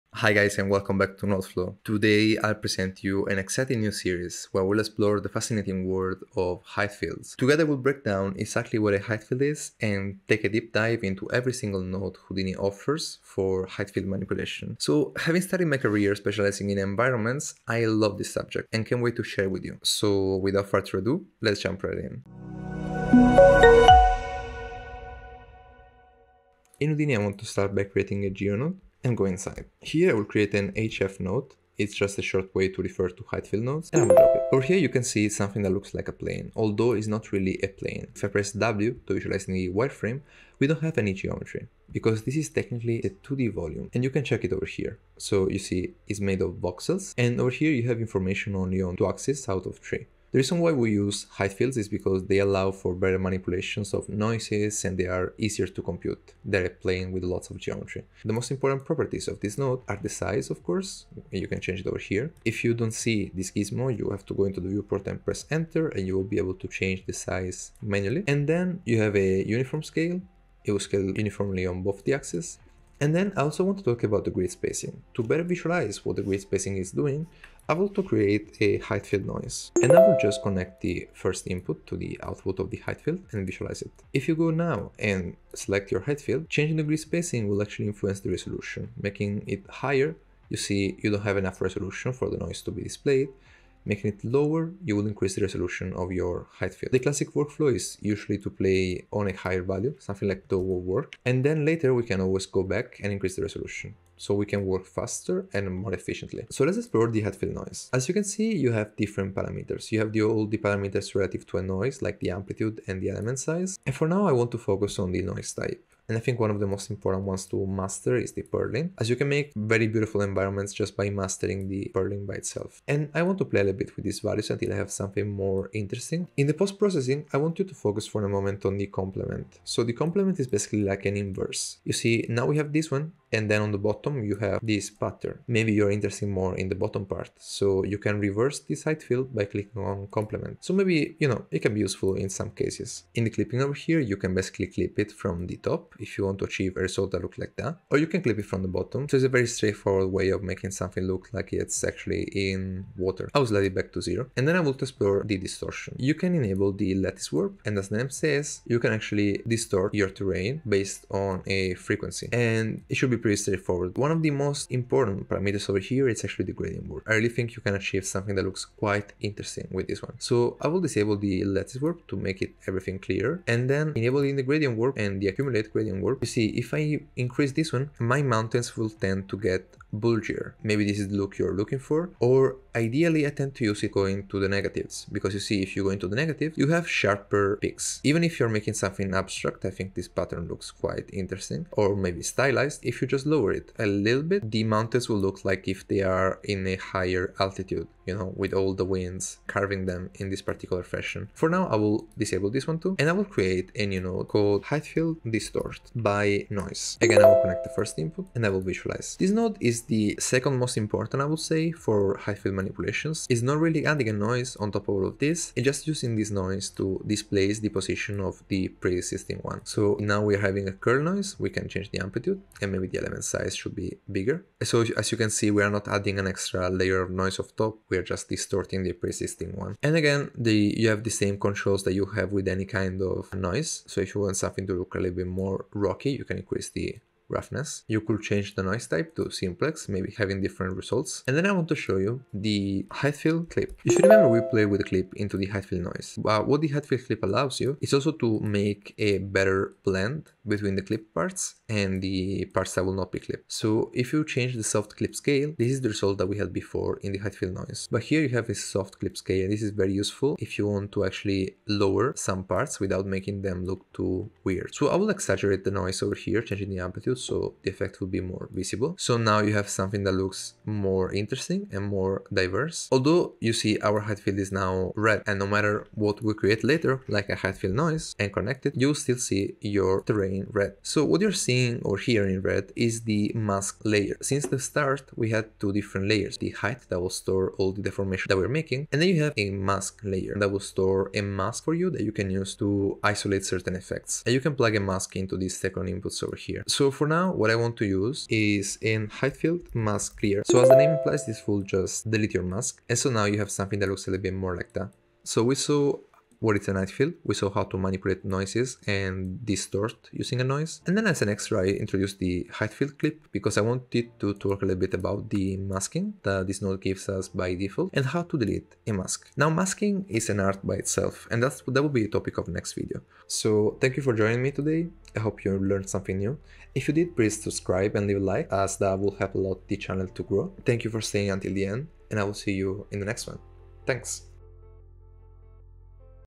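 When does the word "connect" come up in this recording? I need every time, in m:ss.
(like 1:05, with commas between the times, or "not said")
1:20, 3:27, 4:38.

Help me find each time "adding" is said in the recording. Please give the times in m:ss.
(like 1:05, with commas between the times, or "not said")
3:33, 3:45.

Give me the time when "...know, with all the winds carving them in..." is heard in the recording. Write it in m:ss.
3:18.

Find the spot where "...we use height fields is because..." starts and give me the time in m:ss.
0:50.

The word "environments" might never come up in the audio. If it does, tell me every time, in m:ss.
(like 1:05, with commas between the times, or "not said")
0:16, 2:00.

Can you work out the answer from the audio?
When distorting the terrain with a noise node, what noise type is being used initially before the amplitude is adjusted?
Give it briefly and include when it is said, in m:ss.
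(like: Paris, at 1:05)
Curl noise, at 3:40.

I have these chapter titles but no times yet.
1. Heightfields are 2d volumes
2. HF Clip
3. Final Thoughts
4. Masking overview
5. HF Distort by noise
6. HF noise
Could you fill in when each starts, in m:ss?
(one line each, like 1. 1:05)
1. 0:22
2. 4:02
3. 5:05
4. 4:32
5. 3:24
6. 1:18.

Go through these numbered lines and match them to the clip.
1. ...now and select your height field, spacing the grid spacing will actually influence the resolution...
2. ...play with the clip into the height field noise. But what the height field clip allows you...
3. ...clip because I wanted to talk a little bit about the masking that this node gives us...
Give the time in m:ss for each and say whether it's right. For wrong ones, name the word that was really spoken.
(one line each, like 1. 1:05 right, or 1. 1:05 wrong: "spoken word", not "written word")
1. 1:24 wrong: "changing", not "spacing"
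2. 4:04 right
3. 5:12 right.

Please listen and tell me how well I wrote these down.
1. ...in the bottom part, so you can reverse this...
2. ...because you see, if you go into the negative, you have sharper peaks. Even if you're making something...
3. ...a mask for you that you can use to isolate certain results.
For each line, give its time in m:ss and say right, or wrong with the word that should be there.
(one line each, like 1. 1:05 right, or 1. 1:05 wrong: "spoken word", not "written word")
1. 2:16 right
2. 3:05 right
3. 4:51 wrong: "effects", not "results".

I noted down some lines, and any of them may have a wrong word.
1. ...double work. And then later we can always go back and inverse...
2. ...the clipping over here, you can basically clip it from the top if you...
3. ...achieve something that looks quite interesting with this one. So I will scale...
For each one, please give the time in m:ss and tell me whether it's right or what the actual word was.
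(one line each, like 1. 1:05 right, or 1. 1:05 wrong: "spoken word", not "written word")
1. 1:40 wrong: "increase", not "inverse"
2. 2:23 right
3. 2:47 wrong: "disable", not "scale".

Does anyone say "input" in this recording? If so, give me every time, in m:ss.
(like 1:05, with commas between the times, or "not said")
1:21, 3:27, 4:55.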